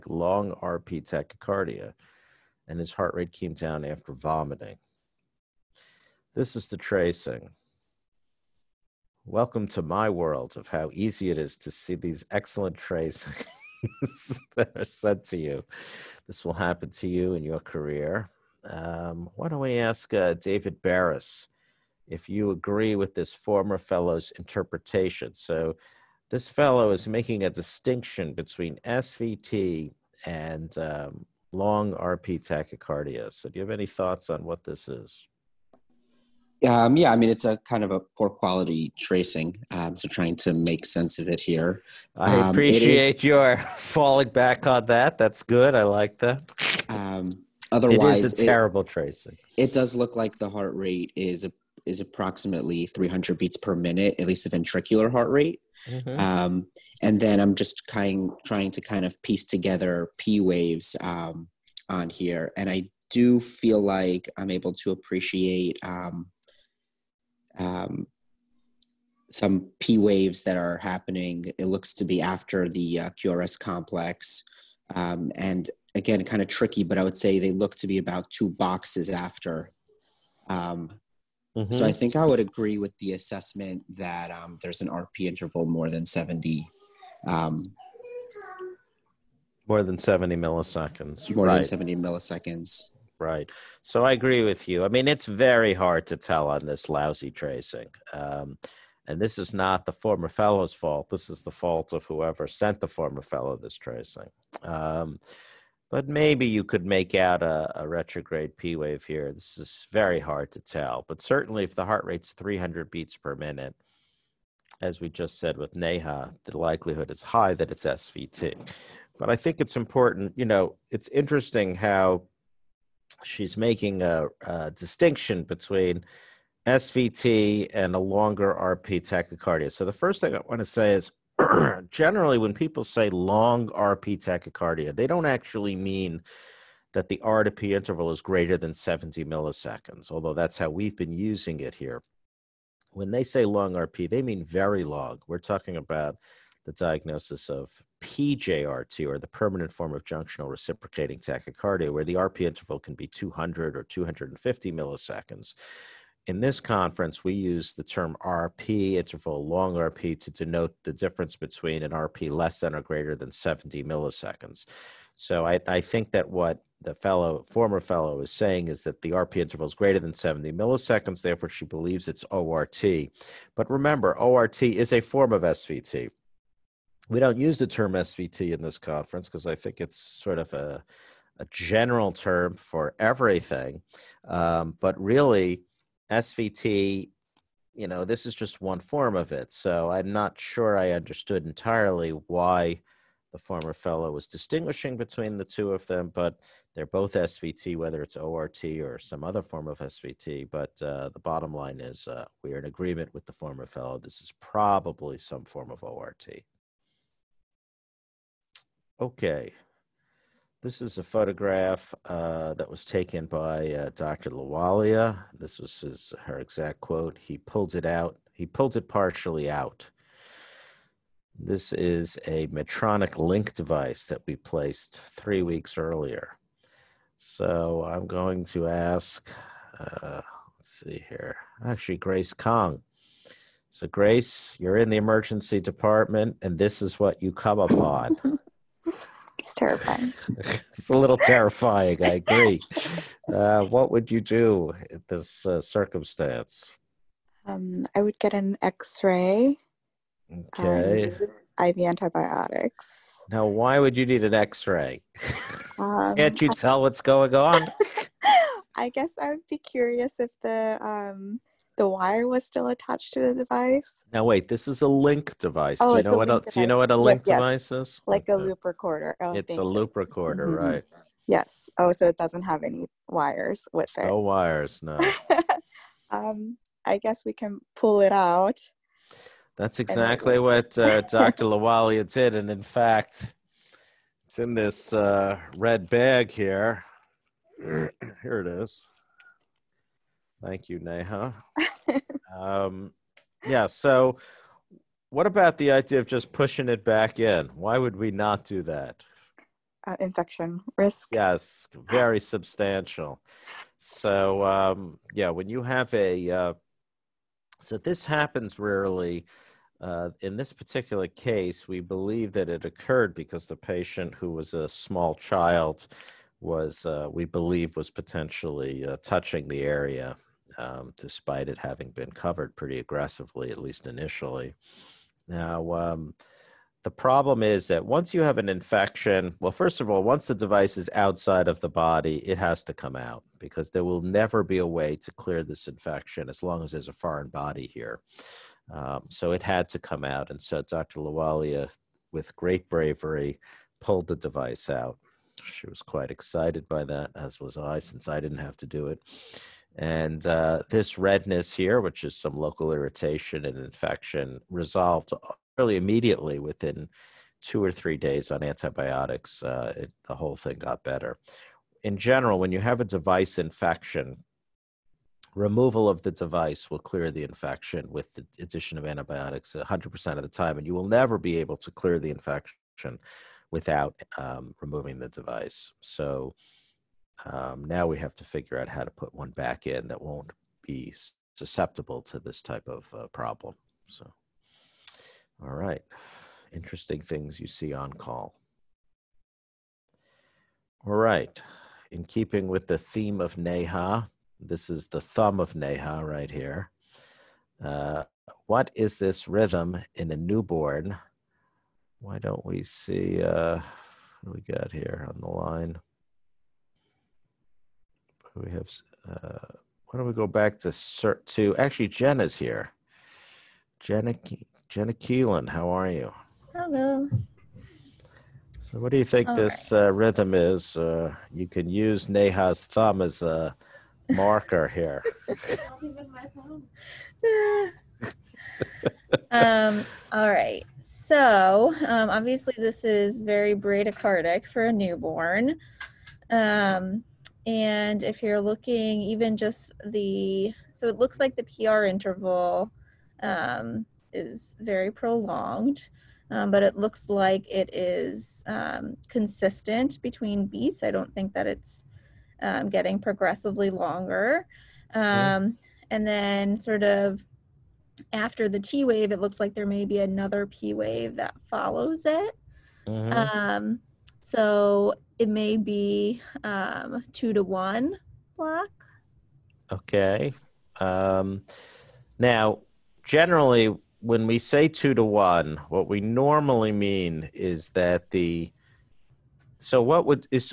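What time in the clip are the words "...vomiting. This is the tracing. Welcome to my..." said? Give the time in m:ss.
0:04.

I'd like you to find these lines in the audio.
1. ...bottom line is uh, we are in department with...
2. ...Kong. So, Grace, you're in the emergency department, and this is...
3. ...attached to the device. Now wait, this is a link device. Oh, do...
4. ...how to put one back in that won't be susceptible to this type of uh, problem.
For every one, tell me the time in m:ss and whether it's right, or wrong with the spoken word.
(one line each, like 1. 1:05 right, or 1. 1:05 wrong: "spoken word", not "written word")
1. 3:21 wrong: "agreement", not "department"
2. 3:52 right
3. 4:22 right
4. 6:18 right.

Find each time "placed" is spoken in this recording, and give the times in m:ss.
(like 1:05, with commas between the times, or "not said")
3:44.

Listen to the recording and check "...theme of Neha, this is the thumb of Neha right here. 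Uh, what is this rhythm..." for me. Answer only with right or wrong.
right.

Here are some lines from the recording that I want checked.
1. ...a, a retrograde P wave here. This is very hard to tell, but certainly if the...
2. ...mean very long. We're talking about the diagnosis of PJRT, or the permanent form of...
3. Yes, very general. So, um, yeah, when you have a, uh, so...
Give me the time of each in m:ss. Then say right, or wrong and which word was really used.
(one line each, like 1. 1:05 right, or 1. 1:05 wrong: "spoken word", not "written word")
1. 1:47 right
2. 2:24 right
3. 5:01 wrong: "substantial", not "general".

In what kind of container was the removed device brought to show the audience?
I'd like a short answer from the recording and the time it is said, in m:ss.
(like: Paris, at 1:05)
red bag, at 4:45.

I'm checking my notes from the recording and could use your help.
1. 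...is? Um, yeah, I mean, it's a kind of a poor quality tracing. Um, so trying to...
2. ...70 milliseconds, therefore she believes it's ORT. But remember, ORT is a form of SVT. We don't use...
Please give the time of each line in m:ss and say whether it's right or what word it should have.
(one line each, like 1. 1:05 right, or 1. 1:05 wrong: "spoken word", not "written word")
1. 0:34 right
2. 2:50 right.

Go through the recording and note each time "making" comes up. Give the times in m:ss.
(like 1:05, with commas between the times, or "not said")
0:27, 2:03.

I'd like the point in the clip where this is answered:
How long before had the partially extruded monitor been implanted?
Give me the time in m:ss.
3:44.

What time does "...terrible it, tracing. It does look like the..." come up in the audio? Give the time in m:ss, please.
0:48.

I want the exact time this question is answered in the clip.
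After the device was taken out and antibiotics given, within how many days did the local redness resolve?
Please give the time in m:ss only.
5:57.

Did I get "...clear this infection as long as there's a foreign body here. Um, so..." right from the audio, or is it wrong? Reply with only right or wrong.
right.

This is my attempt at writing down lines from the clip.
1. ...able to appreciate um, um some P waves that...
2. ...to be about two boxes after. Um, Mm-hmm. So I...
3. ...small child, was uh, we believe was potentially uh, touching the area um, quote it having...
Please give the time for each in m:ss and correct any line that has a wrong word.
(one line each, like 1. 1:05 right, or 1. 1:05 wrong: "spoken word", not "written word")
1. 1:04 right
2. 1:17 right
3. 5:14 wrong: "despite", not "quote".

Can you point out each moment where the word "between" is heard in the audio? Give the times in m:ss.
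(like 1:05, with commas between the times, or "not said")
0:28, 2:05, 2:41, 3:14, 7:30.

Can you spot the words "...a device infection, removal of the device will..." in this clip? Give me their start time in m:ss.
6:02.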